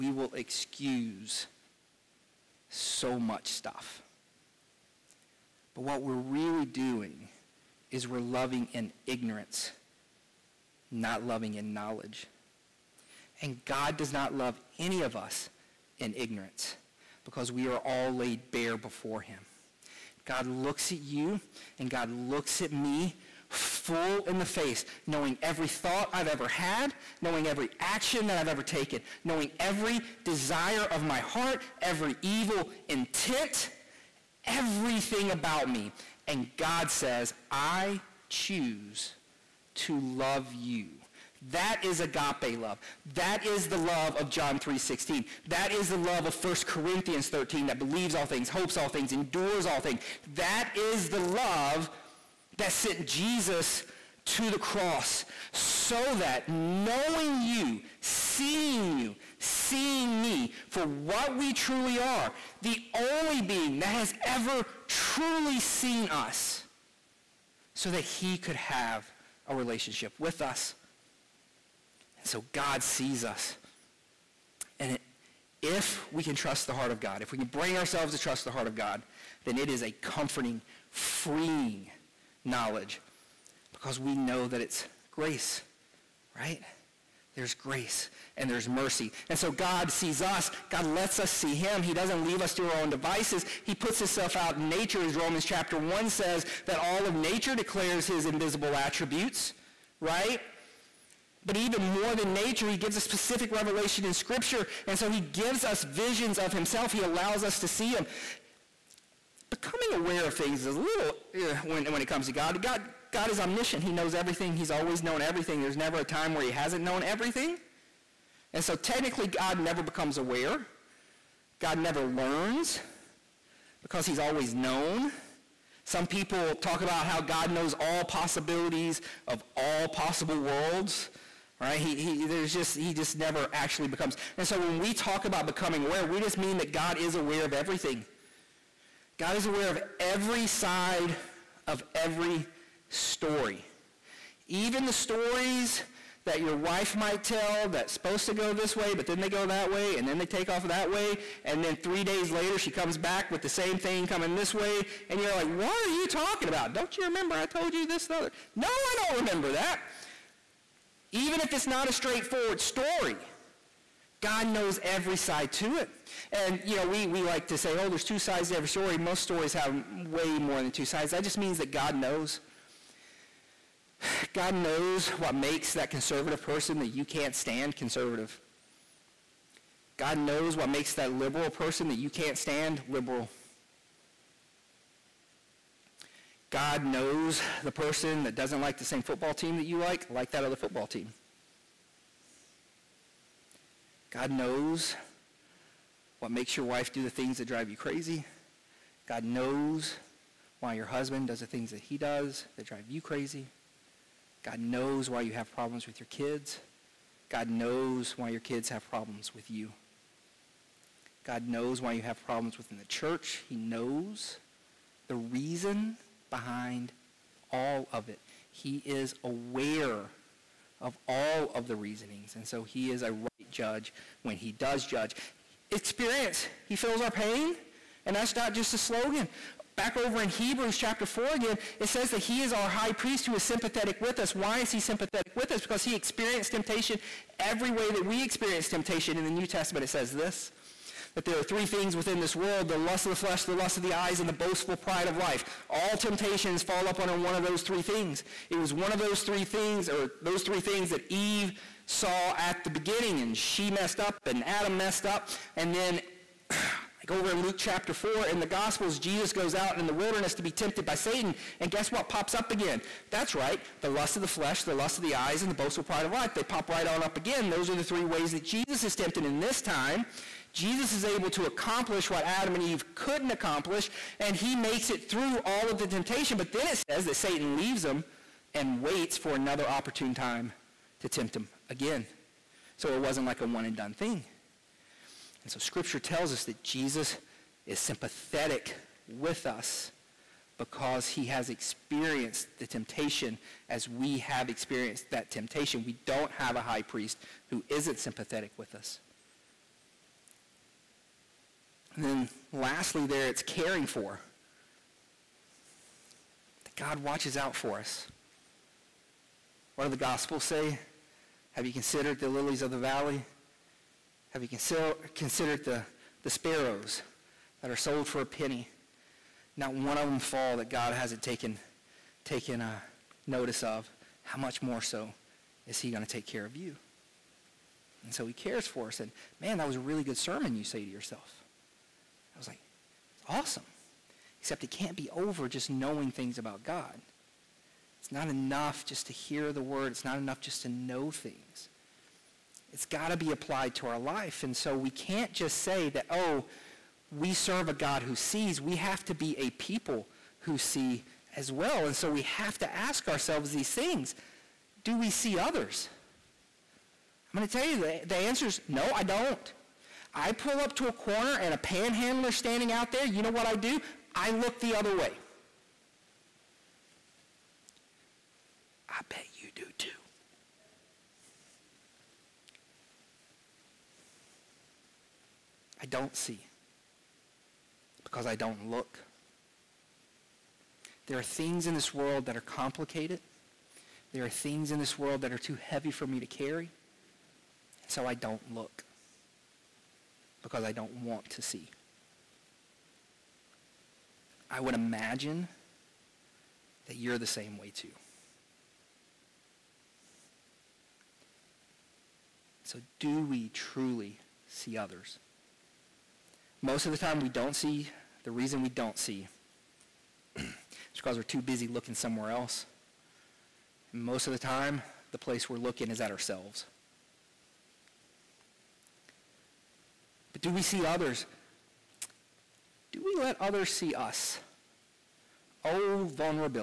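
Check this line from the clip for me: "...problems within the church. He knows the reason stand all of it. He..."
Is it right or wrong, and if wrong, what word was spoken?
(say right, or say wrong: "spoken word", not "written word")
wrong: "behind", not "stand".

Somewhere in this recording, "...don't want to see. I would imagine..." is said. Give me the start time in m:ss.
6:30.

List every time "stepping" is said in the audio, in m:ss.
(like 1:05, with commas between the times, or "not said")
not said.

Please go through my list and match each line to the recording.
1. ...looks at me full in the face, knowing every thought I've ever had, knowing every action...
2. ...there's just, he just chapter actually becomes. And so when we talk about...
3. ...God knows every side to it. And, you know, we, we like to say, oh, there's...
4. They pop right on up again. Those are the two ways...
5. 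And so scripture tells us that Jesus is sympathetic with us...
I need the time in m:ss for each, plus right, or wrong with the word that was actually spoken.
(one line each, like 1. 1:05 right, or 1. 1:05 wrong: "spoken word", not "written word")
1. 0:22 right
2. 2:12 wrong: "never", not "chapter"
3. 2:44 right
4. 4:26 wrong: "three", not "two"
5. 4:45 right.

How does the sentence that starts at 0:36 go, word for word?
And God says, I choose to love you that is agape love.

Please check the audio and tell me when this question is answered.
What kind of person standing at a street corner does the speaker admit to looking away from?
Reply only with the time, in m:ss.
6:01.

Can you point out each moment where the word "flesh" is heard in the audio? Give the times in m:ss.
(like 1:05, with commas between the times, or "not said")
4:03, 4:24.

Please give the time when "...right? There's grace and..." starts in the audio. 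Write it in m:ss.
1:26.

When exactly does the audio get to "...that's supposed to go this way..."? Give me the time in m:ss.
2:27.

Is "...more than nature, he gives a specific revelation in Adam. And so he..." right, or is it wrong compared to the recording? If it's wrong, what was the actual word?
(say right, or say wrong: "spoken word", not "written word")
wrong: "Scripture", not "Adam".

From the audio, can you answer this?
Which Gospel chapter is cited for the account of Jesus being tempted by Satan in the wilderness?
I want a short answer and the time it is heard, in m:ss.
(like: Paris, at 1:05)
Luke 4, at 4:17.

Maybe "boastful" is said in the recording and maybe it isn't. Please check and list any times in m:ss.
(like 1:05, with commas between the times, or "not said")
4:04, 4:25.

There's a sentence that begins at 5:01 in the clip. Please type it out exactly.
And then lastly, there it's caring for.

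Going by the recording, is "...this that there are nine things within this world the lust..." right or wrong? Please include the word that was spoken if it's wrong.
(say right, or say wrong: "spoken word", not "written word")
wrong: "three", not "nine".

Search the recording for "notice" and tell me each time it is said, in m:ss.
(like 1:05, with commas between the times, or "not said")
5:23.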